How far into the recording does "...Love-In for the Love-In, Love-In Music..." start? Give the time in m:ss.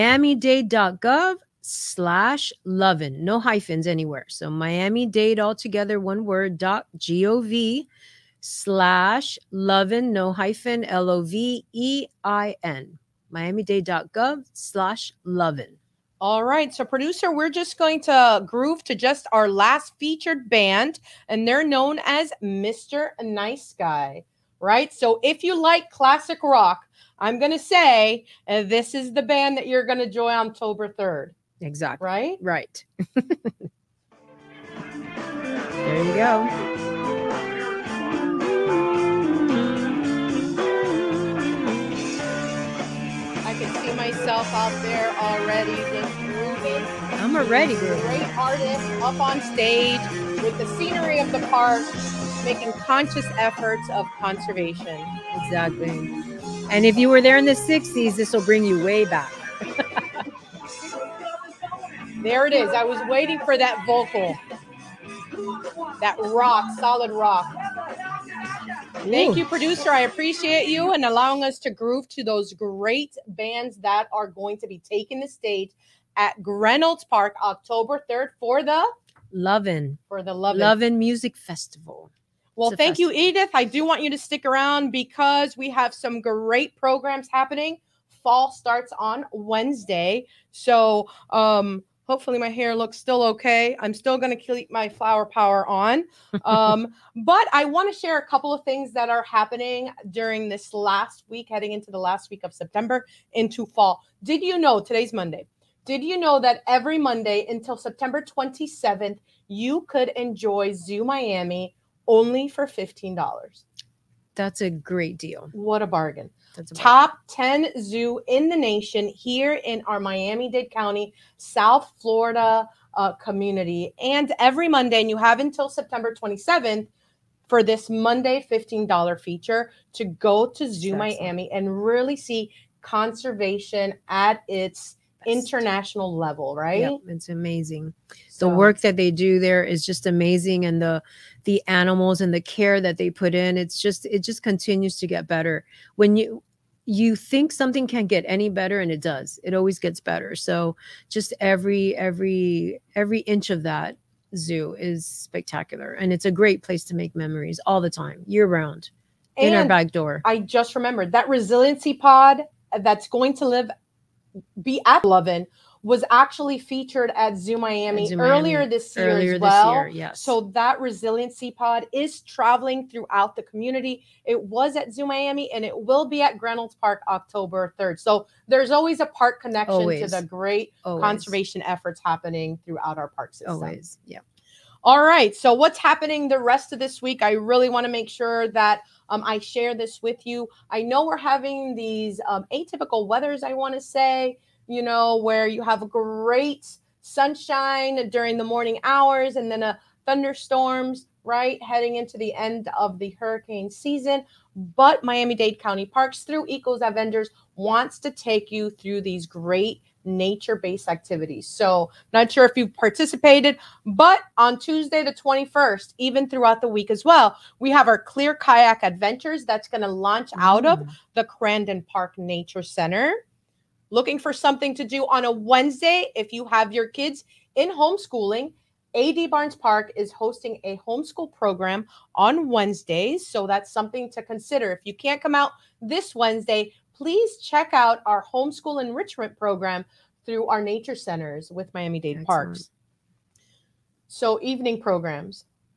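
1:19.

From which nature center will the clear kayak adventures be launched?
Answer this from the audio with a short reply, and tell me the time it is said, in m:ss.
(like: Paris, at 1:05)
Crandon Park Nature Center, at 3:41.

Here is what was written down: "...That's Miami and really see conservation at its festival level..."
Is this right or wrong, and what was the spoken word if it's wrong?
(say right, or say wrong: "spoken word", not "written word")
wrong: "international", not "festival".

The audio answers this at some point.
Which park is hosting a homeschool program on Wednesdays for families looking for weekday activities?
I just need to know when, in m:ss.
3:48.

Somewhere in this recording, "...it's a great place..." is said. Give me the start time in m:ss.
2:36.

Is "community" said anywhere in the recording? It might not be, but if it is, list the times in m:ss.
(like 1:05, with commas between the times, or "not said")
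2:03, 2:53.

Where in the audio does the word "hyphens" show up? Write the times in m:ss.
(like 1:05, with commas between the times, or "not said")
0:03, 0:10.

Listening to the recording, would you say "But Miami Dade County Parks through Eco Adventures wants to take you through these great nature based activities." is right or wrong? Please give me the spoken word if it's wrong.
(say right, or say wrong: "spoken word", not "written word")
right.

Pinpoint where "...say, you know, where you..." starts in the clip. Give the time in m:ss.
3:13.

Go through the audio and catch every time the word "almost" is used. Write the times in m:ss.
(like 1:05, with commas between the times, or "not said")
not said.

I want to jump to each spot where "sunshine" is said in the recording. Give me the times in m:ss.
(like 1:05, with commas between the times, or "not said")
3:17.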